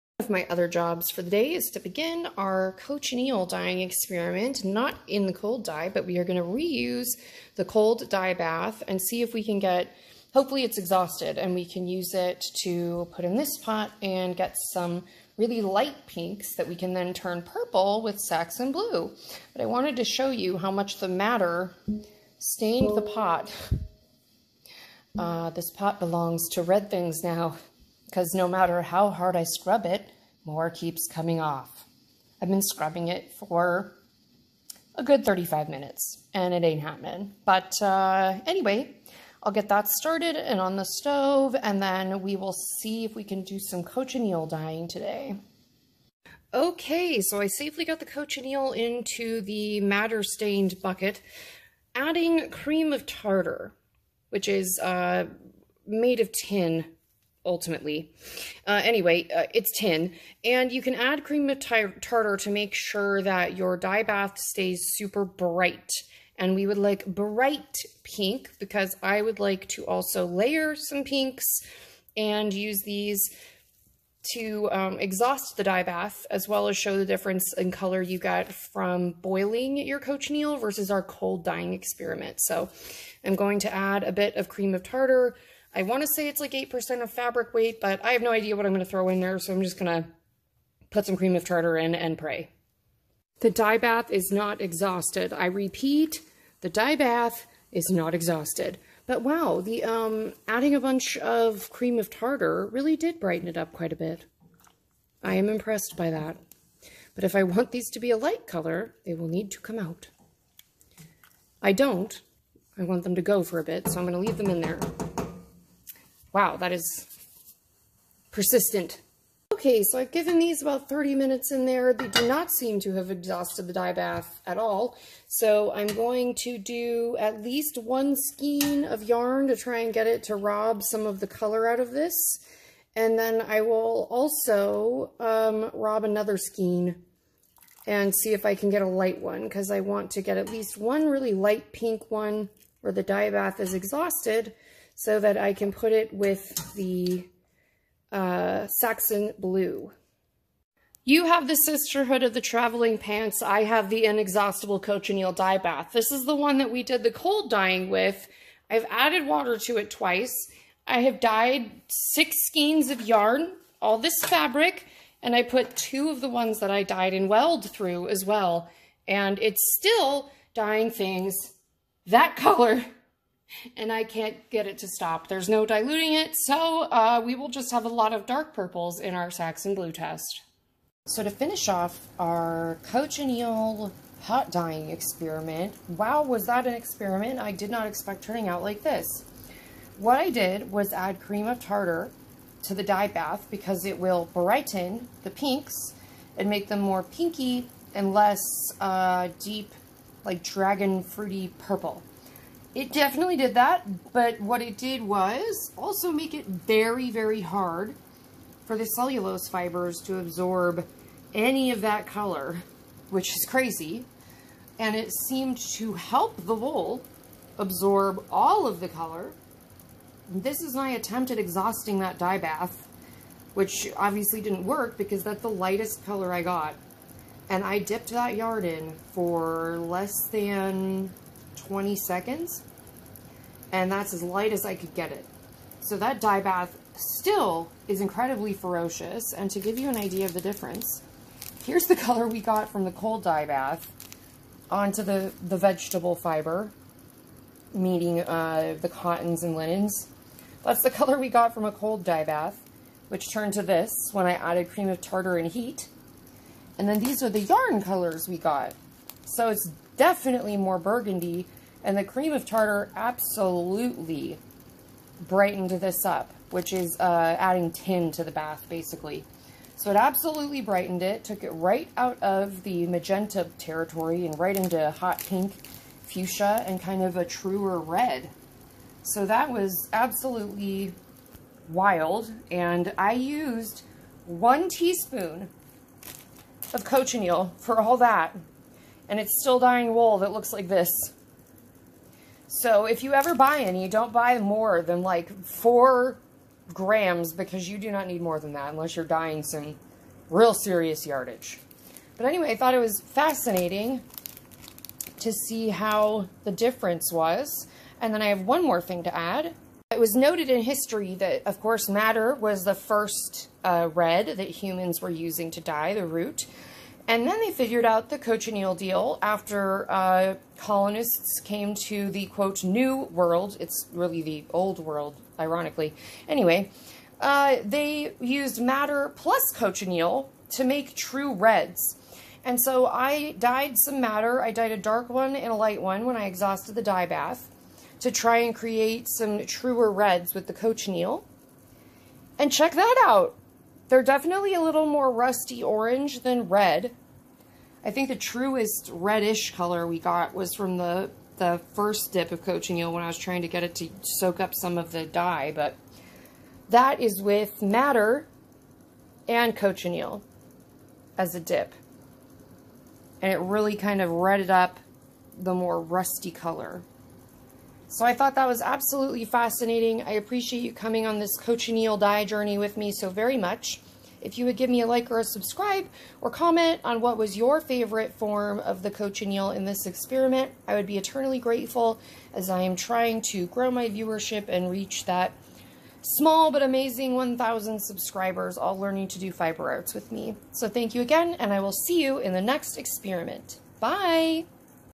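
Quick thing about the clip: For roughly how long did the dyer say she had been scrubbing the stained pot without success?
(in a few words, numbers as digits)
35 minutes.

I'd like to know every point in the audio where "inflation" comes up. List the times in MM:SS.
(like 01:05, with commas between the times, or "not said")
not said.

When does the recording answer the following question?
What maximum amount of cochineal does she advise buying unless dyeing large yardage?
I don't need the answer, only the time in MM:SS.
04:55.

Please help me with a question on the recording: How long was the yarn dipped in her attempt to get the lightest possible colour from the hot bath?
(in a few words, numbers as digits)
less than 20 seconds.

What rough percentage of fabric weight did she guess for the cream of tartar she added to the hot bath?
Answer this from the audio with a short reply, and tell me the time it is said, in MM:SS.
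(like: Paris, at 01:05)
8%, at 01:26.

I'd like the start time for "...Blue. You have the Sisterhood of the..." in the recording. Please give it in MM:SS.
02:29.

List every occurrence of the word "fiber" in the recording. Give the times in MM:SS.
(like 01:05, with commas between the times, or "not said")
03:29, 04:06, 06:29.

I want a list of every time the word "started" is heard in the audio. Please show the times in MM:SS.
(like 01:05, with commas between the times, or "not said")
00:39.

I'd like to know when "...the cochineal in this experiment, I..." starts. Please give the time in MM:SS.
06:18.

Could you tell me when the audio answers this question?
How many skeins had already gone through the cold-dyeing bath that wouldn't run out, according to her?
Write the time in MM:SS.
02:41.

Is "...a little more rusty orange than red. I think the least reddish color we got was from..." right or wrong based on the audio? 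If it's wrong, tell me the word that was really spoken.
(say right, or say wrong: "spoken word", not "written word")
wrong: "truest", not "least".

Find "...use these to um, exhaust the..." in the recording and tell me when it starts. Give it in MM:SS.
01:12.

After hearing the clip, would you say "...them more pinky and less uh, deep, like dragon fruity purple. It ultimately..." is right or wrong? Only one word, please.
wrong.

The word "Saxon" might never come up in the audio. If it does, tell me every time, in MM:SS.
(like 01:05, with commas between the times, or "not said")
00:18, 02:28, 02:59.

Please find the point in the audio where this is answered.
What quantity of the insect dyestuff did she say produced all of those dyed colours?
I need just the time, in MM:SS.
04:44.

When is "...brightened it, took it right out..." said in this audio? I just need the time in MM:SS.
04:30.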